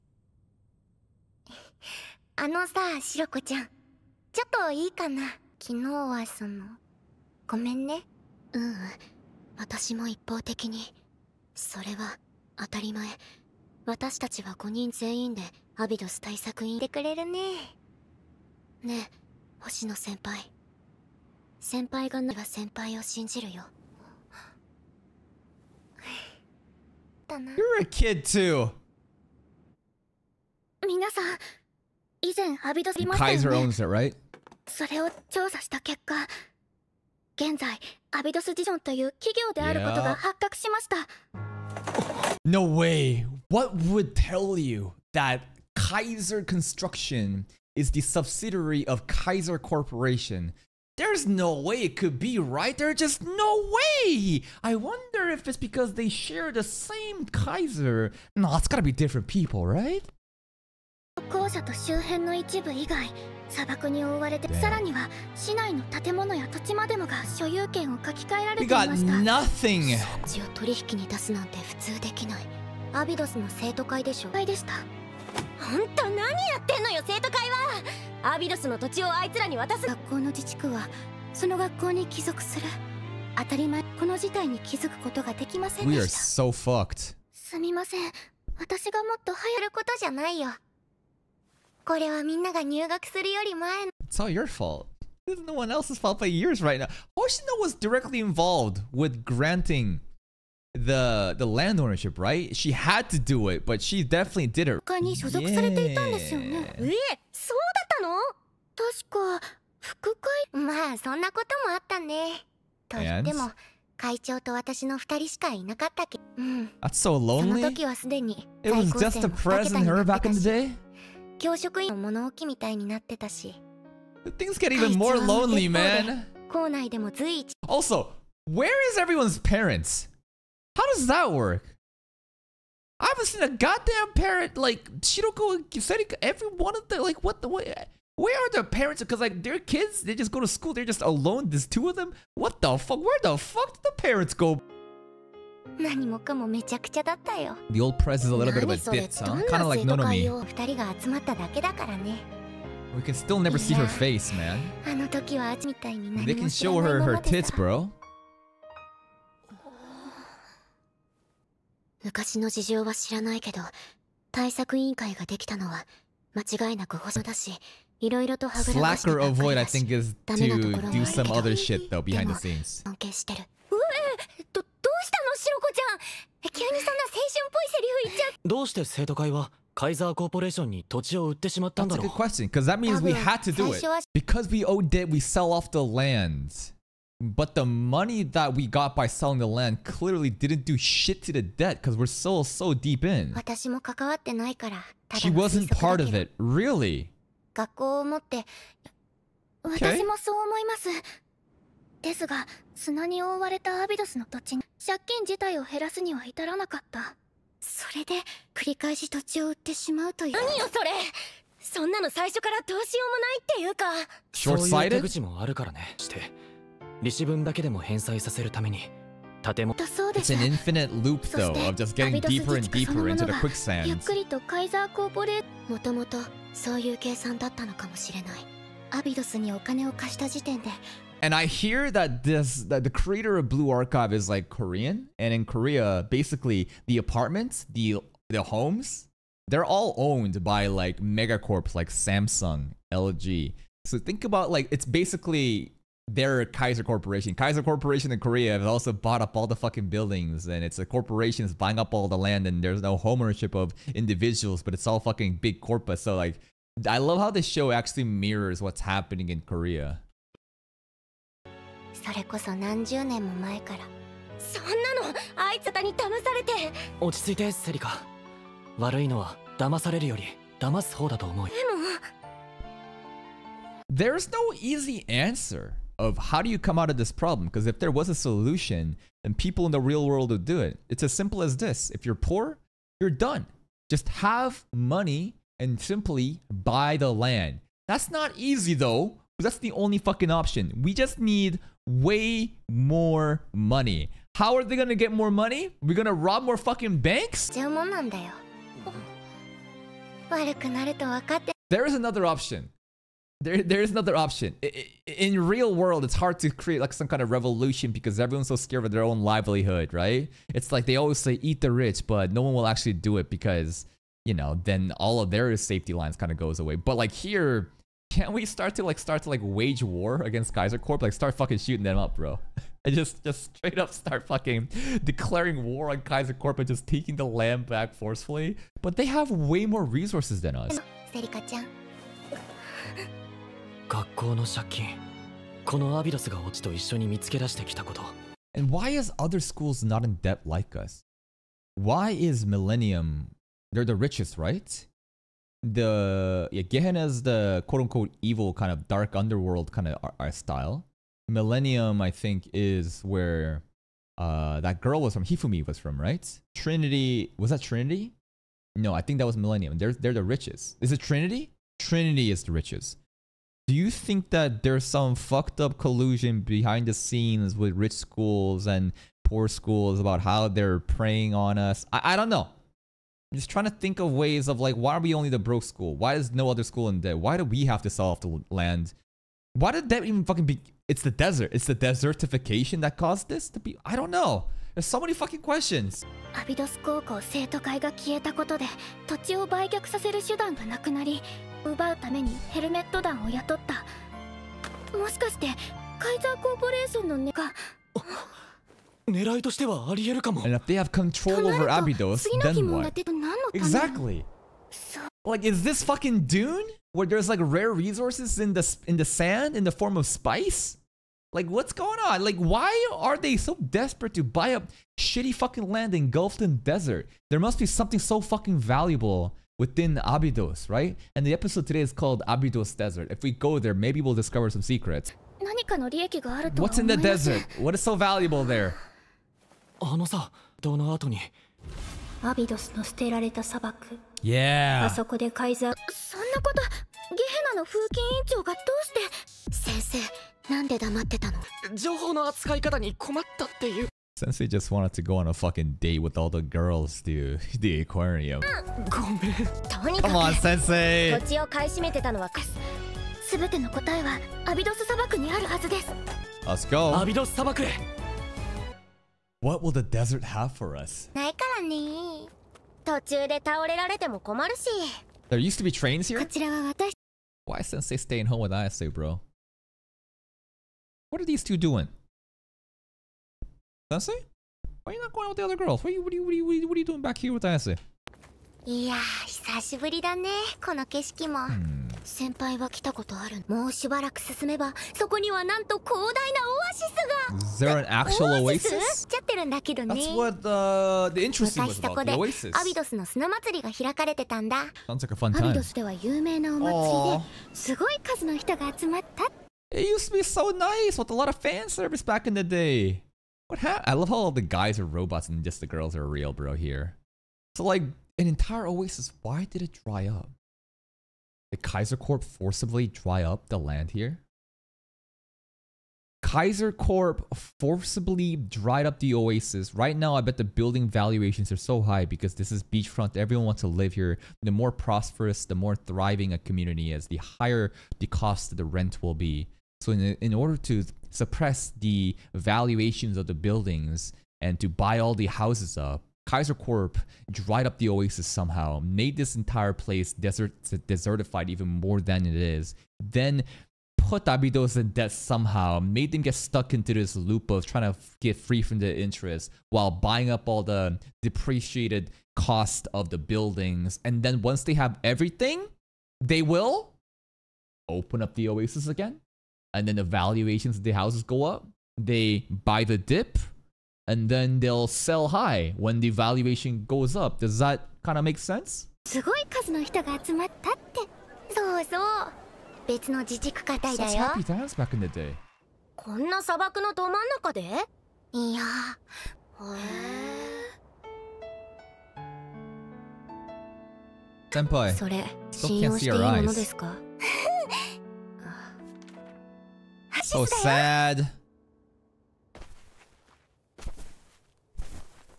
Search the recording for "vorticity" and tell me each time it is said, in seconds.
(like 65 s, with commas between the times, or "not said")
not said.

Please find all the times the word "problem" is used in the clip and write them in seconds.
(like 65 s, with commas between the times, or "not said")
277 s.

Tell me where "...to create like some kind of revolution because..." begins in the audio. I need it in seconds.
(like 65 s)
306 s.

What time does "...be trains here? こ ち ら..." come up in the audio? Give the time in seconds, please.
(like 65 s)
465 s.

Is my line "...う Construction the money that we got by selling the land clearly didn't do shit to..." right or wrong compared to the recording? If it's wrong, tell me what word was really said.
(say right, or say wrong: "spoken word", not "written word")
wrong: "But", not "Construction".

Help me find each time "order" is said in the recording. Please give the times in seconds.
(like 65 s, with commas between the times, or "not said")
530 s.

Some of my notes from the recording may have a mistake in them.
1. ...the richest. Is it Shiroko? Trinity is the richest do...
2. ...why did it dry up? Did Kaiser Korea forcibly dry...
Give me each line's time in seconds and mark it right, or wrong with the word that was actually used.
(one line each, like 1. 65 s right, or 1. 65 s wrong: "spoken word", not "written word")
1. 360 s wrong: "Trinity", not "Shiroko"
2. 509 s wrong: "Corp", not "Korea".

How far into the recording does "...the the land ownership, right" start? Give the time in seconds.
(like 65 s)
100 s.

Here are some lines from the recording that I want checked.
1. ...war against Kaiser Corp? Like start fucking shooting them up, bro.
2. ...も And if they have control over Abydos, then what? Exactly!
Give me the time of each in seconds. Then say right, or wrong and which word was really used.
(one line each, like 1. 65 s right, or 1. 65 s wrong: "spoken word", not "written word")
1. 319 s right
2. 400 s right.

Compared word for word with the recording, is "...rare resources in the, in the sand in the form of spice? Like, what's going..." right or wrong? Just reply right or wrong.
right.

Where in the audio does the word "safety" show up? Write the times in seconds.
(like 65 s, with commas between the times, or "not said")
315 s.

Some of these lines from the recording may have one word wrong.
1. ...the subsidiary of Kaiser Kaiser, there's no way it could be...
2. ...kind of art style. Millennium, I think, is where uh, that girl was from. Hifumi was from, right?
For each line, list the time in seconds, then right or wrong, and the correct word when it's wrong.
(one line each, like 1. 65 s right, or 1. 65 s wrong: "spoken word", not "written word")
1. 47 s wrong: "Corporation", not "Kaiser"
2. 349 s right.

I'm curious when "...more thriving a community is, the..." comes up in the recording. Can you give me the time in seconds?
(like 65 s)
525 s.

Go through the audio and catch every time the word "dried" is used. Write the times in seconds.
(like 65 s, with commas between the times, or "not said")
518 s, 537 s.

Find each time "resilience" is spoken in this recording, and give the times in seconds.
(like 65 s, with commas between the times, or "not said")
not said.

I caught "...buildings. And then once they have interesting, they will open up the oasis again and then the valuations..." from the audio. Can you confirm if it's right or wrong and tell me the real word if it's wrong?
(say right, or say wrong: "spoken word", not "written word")
wrong: "everything", not "interesting".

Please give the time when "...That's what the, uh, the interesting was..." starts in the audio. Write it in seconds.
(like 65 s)
489 s.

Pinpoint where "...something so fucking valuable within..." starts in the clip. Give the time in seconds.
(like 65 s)
417 s.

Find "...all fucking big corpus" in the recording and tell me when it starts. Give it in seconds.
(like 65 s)
254 s.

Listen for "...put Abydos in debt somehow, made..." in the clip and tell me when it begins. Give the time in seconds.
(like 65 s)
543 s.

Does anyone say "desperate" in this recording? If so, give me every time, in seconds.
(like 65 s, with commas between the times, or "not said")
413 s.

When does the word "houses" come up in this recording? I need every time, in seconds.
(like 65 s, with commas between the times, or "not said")
535 s, 560 s.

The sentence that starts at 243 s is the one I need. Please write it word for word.
So think about like it's basically they Kaiser Corporation.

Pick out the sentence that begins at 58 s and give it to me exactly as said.
No, it's gotta be different people, right?